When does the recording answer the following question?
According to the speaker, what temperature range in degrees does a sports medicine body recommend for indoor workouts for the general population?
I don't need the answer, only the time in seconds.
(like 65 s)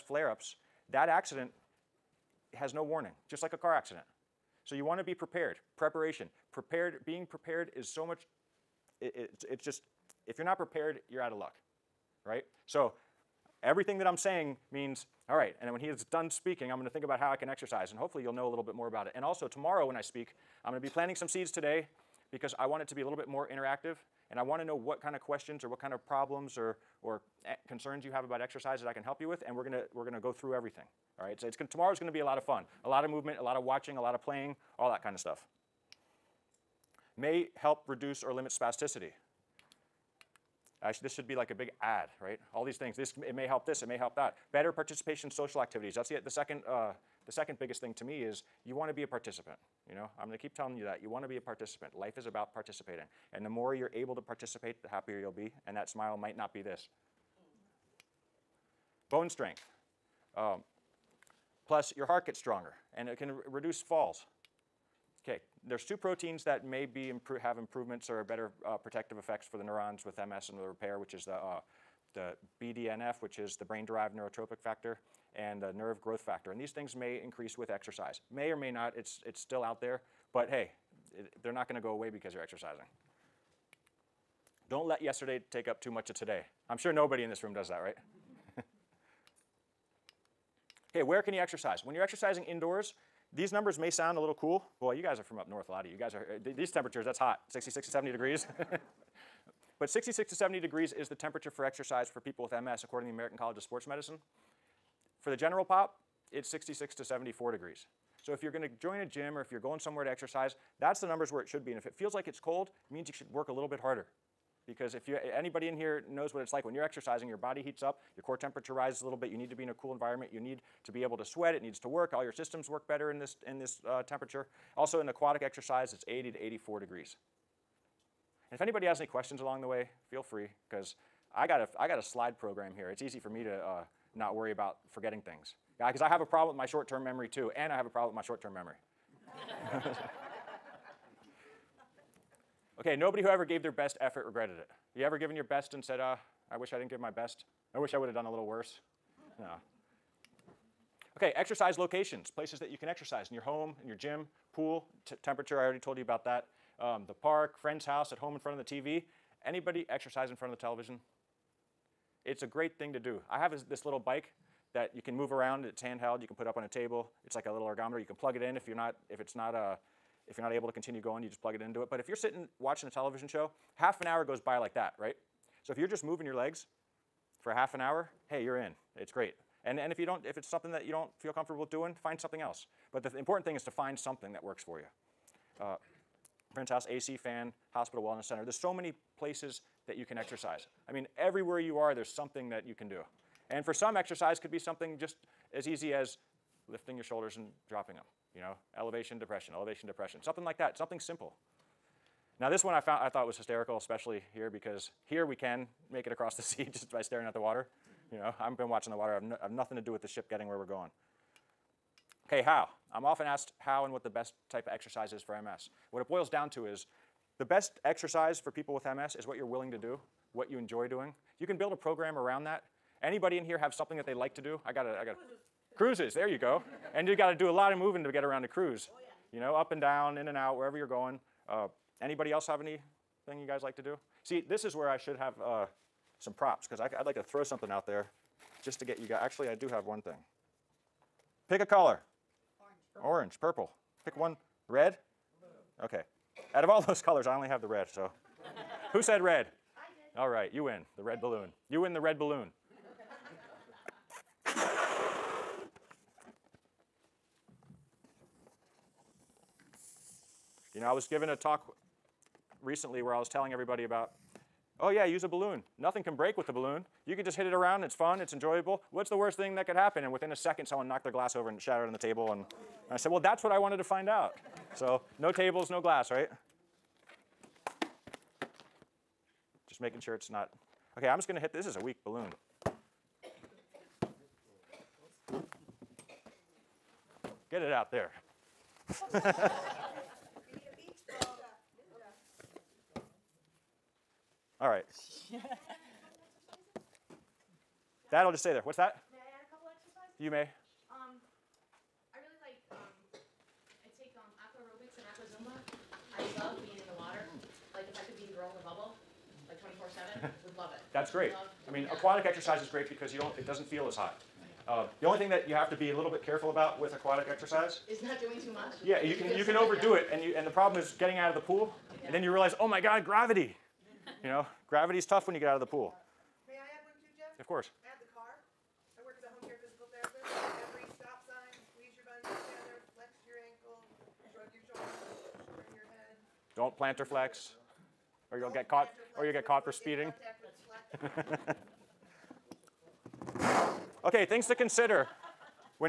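106 s.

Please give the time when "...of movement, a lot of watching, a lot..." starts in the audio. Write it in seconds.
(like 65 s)
33 s.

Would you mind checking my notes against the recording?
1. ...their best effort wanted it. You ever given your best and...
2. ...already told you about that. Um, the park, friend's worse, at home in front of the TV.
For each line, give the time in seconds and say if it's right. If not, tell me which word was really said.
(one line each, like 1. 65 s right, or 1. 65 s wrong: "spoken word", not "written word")
1. 143 s wrong: "regretted", not "wanted"
2. 155 s wrong: "house", not "worse".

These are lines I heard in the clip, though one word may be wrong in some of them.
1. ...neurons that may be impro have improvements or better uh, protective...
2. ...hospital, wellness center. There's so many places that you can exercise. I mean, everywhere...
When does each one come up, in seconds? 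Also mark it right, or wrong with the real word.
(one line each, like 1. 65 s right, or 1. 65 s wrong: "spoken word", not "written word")
1. 65 s wrong: "proteins", not "neurons"
2. 187 s right.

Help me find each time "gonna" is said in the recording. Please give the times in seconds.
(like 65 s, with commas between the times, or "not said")
31 s, 81 s, 108 s, 281 s.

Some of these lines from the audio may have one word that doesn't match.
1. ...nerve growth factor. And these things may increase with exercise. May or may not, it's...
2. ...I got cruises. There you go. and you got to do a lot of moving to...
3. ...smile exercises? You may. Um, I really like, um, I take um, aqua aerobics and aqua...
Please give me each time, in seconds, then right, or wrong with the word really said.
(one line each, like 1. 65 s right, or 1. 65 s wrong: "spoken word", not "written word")
1. 75 s right
2. 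224 s right
3. 299 s wrong: "couple", not "smile".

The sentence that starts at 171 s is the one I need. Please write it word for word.
But if you're sitting watching a television show, half an hour goes by like that, right?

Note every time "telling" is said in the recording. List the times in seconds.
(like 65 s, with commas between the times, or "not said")
50 s, 263 s.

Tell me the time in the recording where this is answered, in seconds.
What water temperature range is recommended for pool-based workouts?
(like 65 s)
126 s.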